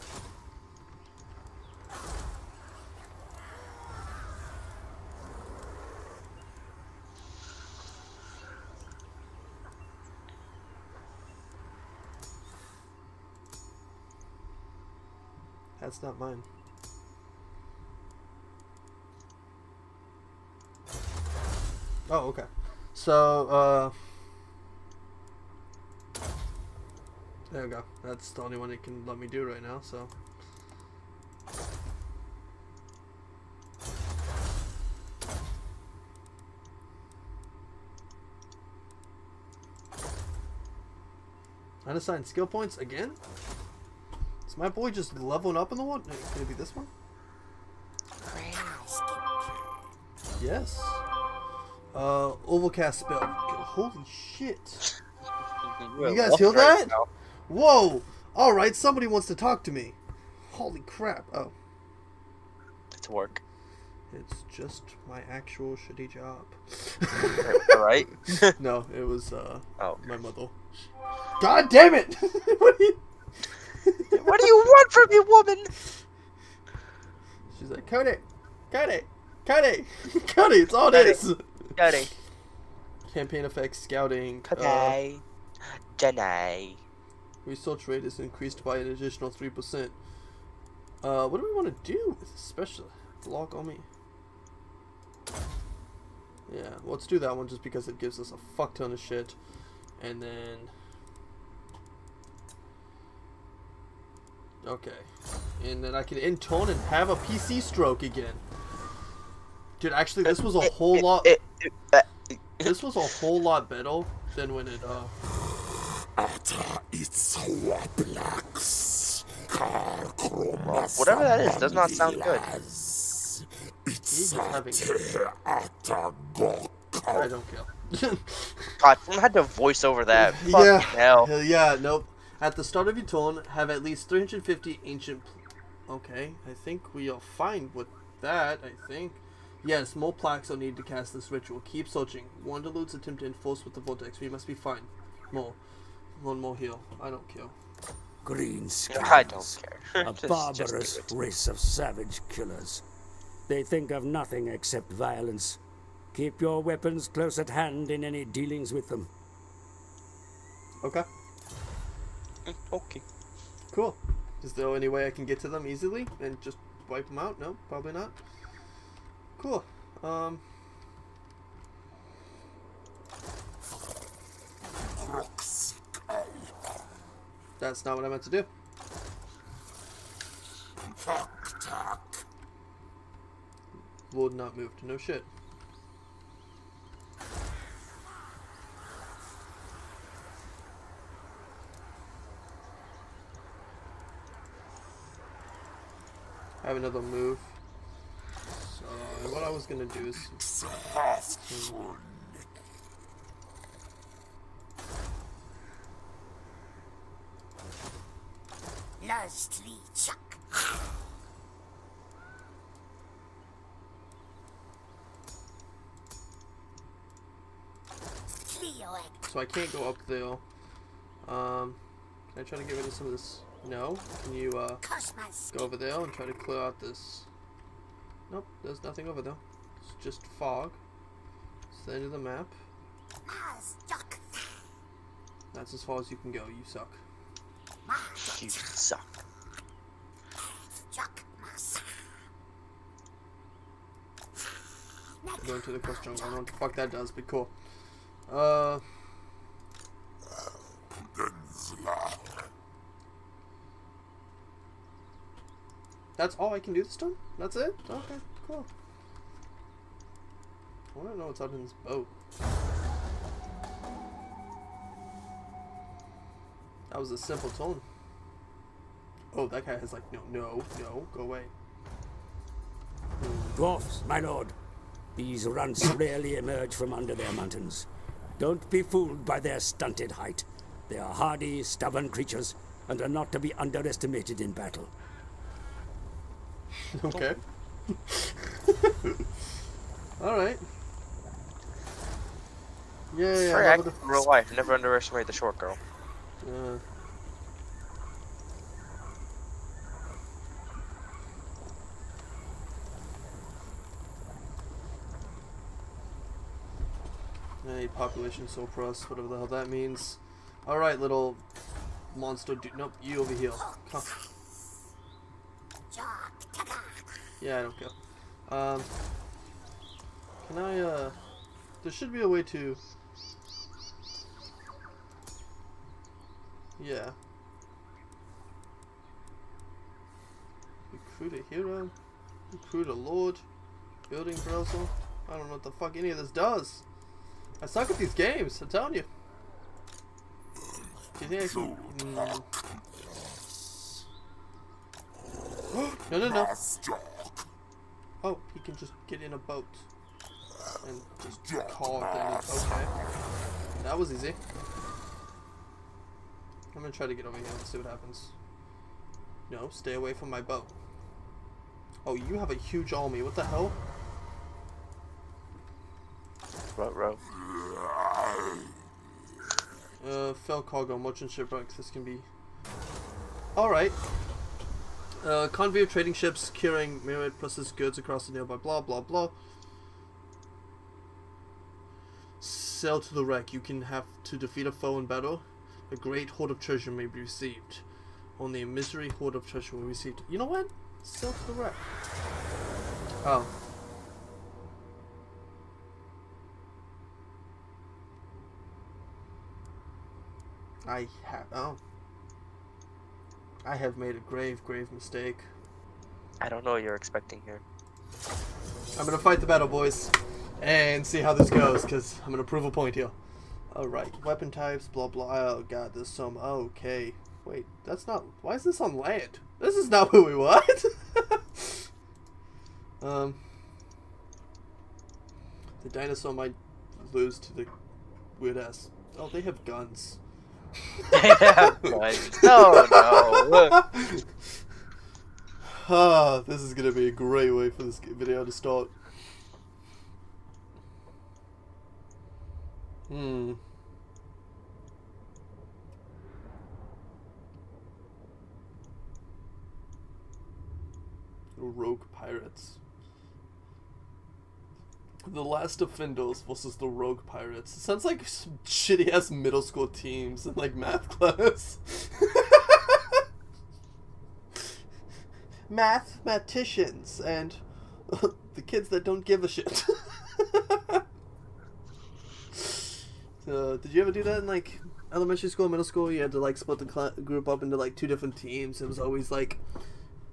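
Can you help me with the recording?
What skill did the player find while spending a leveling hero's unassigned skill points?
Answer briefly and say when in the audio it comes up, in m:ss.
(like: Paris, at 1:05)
Overcast spell, at 0:52.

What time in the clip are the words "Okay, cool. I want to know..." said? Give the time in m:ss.
4:17.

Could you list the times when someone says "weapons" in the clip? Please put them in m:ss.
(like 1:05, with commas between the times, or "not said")
2:36, 6:54.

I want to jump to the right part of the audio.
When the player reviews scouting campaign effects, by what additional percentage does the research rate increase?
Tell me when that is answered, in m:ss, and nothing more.
1:29.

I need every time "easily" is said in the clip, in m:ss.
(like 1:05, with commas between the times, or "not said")
2:45.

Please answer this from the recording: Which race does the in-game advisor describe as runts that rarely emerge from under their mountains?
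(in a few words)
Dwarfs.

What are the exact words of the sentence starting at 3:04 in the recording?
Would not move to no shit.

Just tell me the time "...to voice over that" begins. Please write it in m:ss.
2:09.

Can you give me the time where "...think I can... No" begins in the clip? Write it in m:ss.
5:41.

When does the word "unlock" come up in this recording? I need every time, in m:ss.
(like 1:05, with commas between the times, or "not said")
not said.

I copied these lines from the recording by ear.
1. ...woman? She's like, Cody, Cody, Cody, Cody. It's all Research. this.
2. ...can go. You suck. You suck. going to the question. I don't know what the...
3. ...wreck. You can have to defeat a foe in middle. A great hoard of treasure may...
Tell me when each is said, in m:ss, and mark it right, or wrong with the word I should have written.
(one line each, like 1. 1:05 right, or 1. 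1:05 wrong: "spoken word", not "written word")
1. 1:15 wrong: "Cody", not "Research"
2. 3:56 right
3. 6:23 wrong: "battle", not "middle".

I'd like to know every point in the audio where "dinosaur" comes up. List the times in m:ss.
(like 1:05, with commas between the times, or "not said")
7:05.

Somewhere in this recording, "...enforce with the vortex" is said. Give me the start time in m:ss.
2:23.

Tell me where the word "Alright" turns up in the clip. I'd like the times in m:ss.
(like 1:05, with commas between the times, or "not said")
4:50, 5:10, 6:13, 6:53.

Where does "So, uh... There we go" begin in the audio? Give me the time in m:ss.
0:22.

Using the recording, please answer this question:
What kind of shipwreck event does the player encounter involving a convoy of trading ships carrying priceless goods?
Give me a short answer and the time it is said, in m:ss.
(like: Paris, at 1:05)
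Merchant shipwrecks, at 6:10.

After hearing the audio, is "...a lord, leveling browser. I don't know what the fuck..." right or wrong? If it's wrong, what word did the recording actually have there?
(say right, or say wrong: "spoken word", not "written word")
wrong: "building", not "leveling".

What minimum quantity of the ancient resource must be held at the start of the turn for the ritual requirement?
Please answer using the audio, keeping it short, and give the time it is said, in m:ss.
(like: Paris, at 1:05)
350, at 2:14.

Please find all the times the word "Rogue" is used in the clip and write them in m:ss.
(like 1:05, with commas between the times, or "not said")
7:31, 7:36.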